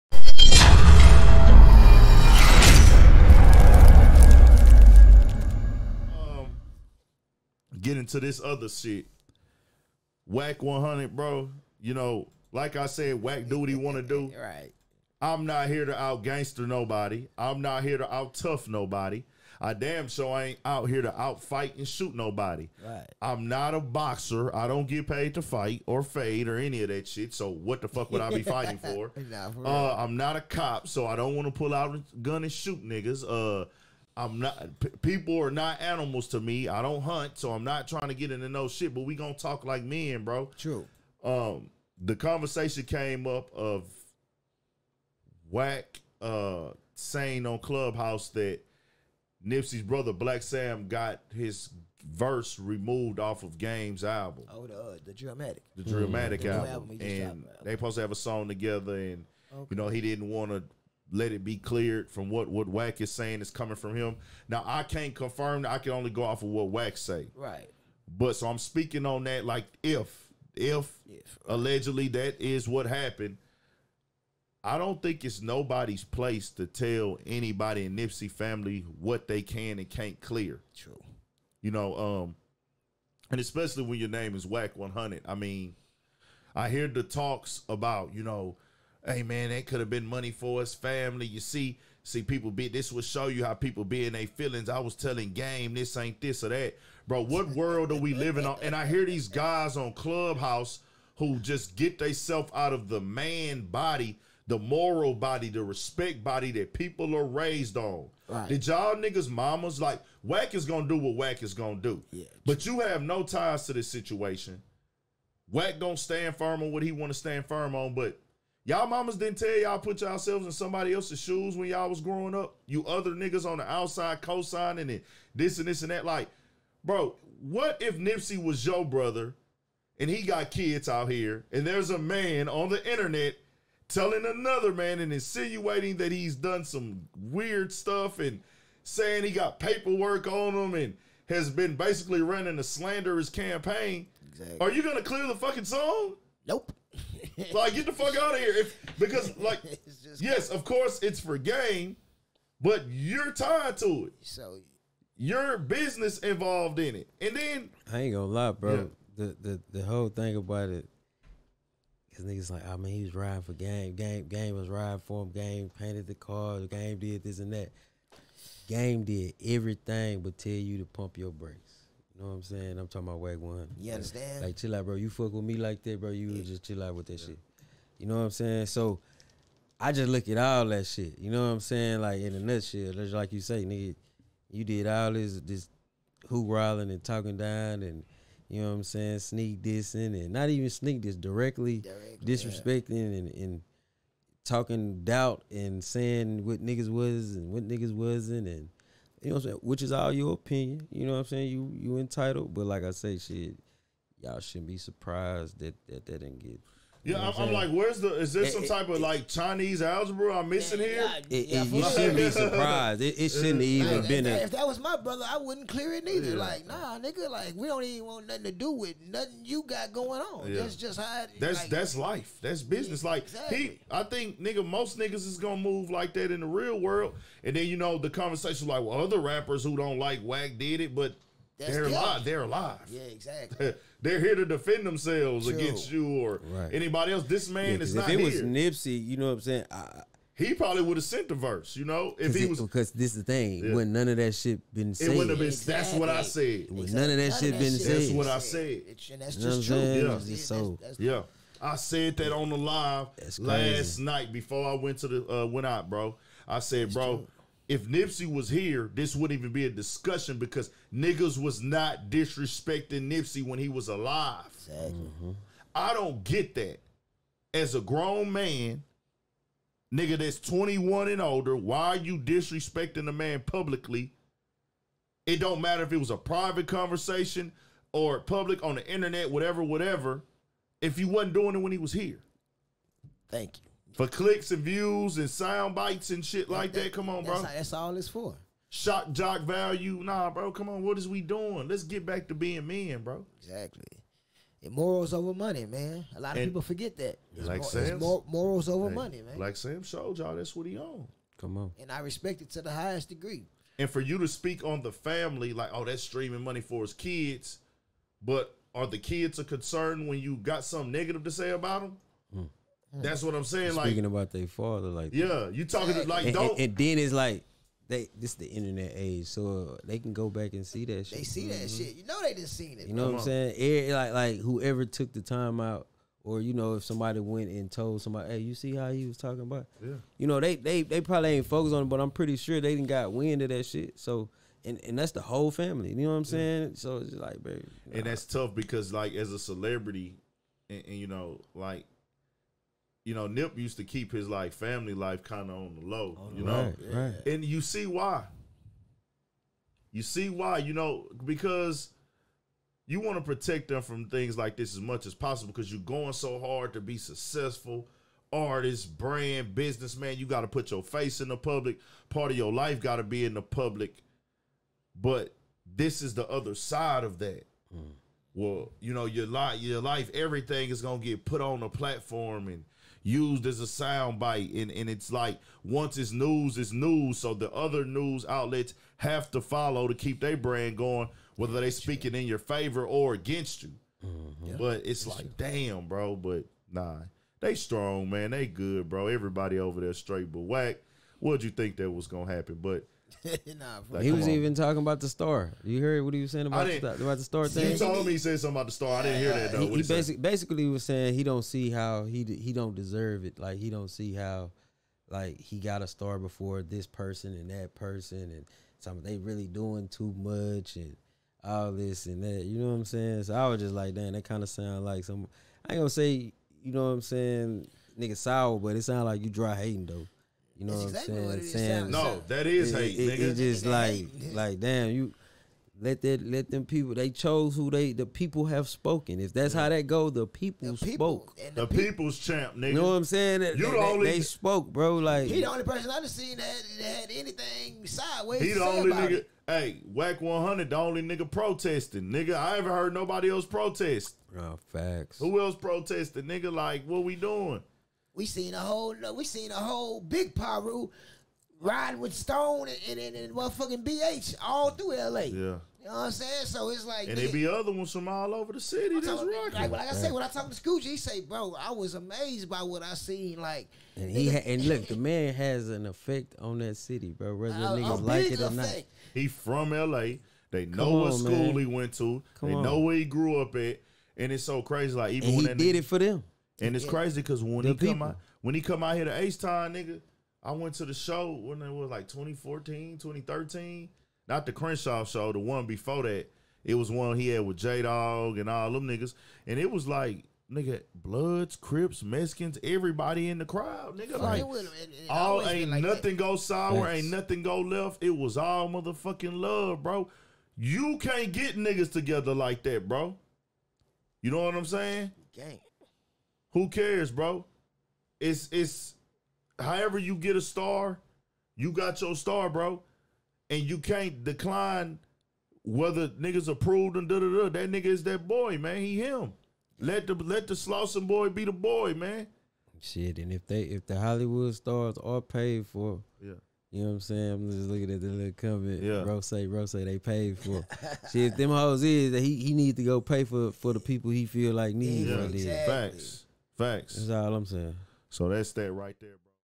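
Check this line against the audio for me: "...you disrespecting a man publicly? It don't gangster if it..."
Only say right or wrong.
wrong.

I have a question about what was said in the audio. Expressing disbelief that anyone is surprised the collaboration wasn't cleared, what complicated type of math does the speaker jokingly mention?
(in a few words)
Chinese algebra.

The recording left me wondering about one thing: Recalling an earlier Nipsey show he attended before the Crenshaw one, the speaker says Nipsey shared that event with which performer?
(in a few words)
J Dog.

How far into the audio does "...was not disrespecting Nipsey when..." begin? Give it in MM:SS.
04:21.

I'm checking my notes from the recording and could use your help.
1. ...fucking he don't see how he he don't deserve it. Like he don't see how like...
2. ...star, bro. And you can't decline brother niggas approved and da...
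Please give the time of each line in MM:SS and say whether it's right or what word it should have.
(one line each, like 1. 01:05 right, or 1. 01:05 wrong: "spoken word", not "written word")
1. 06:40 wrong: "saying", not "fucking"
2. 08:32 wrong: "whether", not "brother".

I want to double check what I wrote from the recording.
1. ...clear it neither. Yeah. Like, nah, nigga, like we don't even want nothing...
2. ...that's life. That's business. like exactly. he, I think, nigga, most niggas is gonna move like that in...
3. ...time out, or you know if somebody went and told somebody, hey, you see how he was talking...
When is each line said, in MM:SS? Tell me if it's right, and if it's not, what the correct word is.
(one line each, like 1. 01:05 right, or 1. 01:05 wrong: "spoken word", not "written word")
1. 03:35 right
2. 03:41 right
3. 05:25 right.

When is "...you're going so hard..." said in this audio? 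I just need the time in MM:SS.
05:55.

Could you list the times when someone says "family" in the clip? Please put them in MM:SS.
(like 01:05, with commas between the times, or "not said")
01:18, 01:30, 05:04, 05:35, 05:44.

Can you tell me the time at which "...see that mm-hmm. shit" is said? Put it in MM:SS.
05:21.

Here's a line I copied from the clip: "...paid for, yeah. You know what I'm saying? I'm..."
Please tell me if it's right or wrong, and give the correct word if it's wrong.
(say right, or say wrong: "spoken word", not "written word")
right.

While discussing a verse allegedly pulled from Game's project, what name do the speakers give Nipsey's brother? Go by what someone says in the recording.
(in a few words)
Black Sam.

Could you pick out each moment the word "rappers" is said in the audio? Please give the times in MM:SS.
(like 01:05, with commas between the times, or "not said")
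03:49.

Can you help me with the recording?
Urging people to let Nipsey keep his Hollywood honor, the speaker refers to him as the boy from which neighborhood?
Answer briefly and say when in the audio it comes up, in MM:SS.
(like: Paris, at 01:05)
Slauson, at 08:40.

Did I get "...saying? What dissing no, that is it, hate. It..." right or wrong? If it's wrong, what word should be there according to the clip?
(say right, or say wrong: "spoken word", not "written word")
wrong: "saying", not "dissing".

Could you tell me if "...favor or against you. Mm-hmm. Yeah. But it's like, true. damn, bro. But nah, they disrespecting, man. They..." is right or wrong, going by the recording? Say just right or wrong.
wrong.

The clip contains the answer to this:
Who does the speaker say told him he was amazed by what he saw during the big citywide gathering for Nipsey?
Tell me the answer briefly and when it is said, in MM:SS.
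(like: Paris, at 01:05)
Scooch, at 07:40.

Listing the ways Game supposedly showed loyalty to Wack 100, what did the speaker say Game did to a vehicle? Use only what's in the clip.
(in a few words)
Painted the car.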